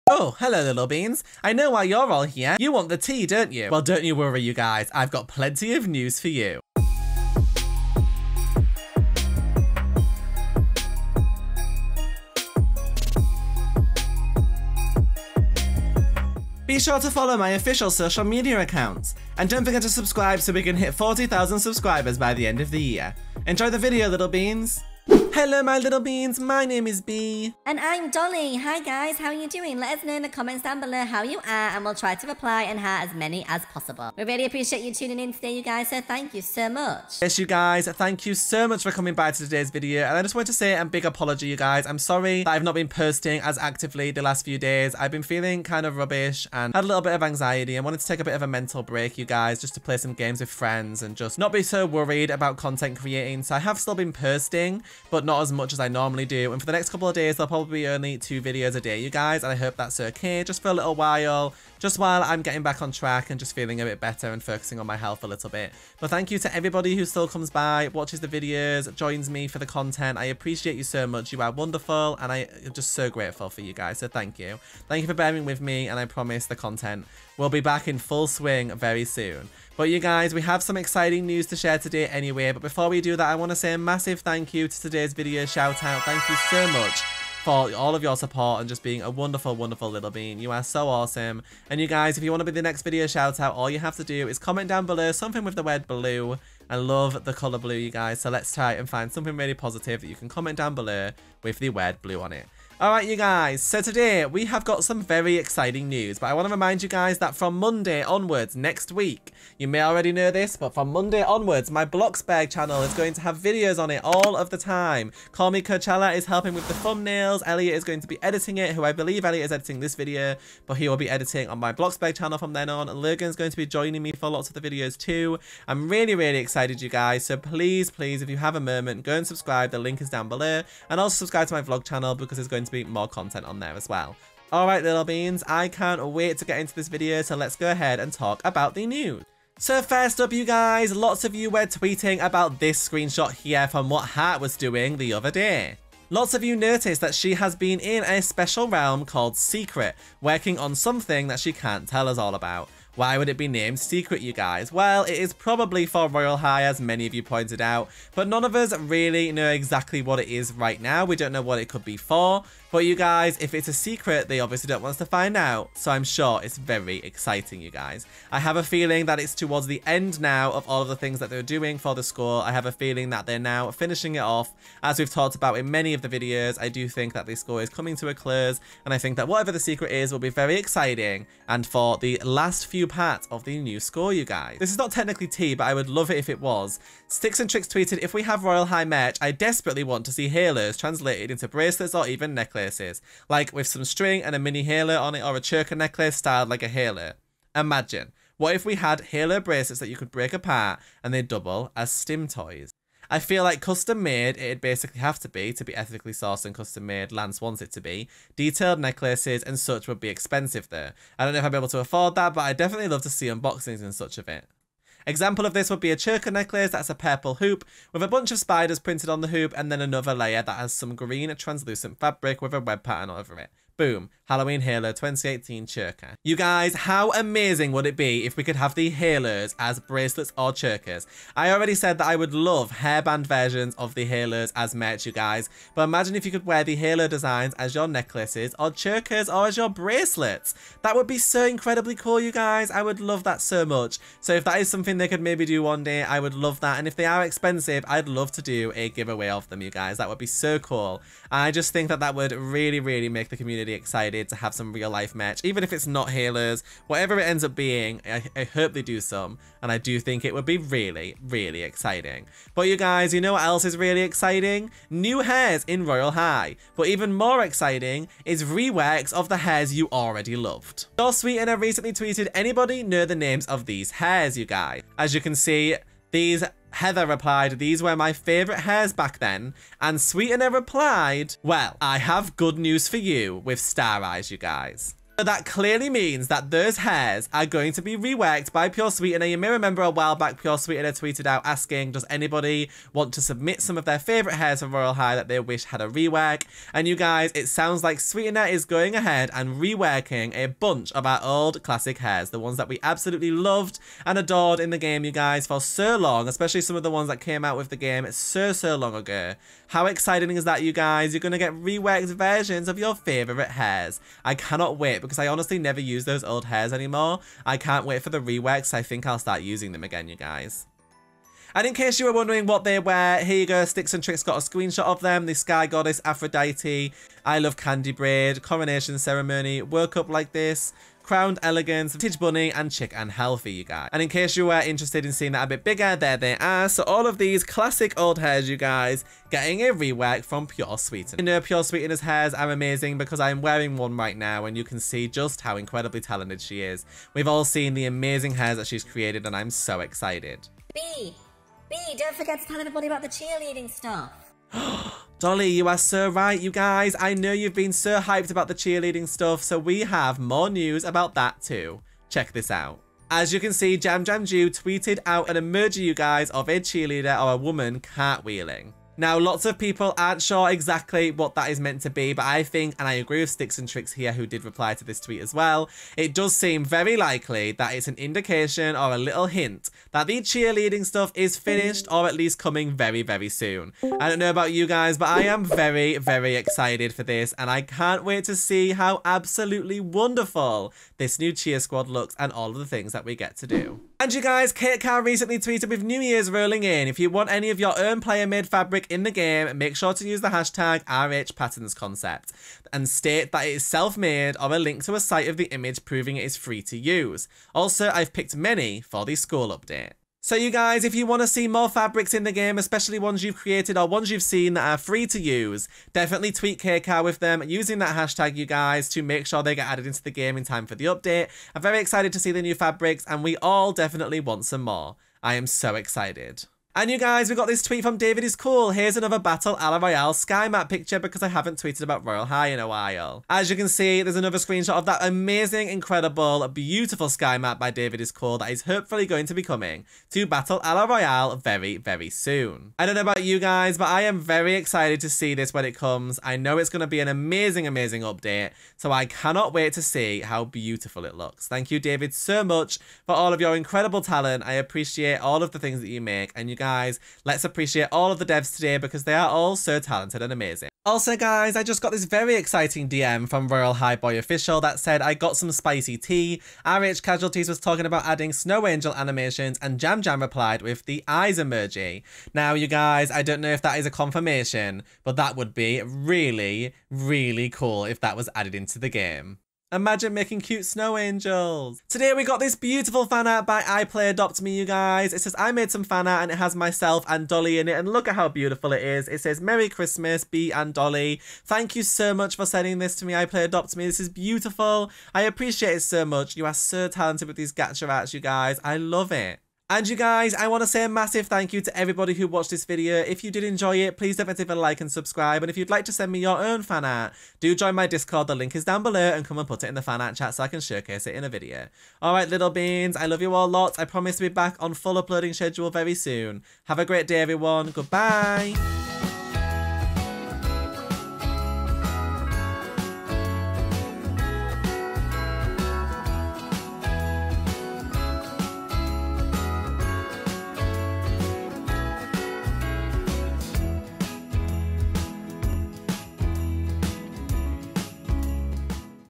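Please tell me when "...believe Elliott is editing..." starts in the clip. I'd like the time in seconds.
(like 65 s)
118 s.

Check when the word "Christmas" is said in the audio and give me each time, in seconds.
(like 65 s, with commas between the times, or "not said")
489 s.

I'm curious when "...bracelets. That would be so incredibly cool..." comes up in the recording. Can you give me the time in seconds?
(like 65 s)
239 s.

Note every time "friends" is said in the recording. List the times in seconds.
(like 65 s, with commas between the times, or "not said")
50 s.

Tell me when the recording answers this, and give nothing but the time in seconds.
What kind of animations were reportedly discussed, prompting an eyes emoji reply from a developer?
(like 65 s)
468 s.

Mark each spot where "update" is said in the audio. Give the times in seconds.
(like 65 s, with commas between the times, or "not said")
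409 s, 420 s, 448 s.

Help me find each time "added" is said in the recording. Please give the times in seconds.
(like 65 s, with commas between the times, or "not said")
419 s, 478 s.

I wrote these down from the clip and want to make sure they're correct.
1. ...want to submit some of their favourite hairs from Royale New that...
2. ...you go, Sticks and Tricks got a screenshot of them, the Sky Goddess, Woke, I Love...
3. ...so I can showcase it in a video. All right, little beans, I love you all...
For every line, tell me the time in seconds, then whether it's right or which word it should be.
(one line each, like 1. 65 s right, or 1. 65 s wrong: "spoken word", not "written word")
1. 292 s wrong: "High", not "New"
2. 323 s wrong: "Aphrodite", not "Woke"
3. 510 s right.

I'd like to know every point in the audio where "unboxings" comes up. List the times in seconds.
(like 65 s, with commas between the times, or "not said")
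213 s.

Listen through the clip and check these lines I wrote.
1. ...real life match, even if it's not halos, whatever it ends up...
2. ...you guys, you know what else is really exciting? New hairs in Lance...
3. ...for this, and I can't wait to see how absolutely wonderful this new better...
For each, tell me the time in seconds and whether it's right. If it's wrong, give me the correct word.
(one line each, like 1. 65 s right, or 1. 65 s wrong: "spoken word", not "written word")
1. 254 s right
2. 262 s wrong: "Royale", not "Lance"
3. 386 s wrong: "cheer", not "better".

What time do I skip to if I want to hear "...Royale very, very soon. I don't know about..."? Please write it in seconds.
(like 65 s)
440 s.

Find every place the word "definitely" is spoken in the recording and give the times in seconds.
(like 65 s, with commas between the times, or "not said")
212 s, 415 s, 423 s.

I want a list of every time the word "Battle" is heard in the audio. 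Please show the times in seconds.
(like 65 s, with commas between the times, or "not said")
429 s, 440 s.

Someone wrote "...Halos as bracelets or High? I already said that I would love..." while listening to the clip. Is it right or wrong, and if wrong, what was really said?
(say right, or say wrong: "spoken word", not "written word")
wrong: "Chokers", not "High".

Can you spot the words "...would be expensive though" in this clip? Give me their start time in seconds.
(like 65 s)
209 s.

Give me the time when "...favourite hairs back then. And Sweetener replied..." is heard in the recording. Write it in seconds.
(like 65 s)
278 s.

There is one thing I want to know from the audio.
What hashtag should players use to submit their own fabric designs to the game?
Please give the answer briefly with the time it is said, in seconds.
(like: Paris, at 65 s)
RHPatternsConcept, at 400 s.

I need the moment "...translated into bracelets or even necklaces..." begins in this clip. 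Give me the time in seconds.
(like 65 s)
190 s.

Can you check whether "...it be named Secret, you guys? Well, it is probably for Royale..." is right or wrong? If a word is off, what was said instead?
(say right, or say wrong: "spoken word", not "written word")
right.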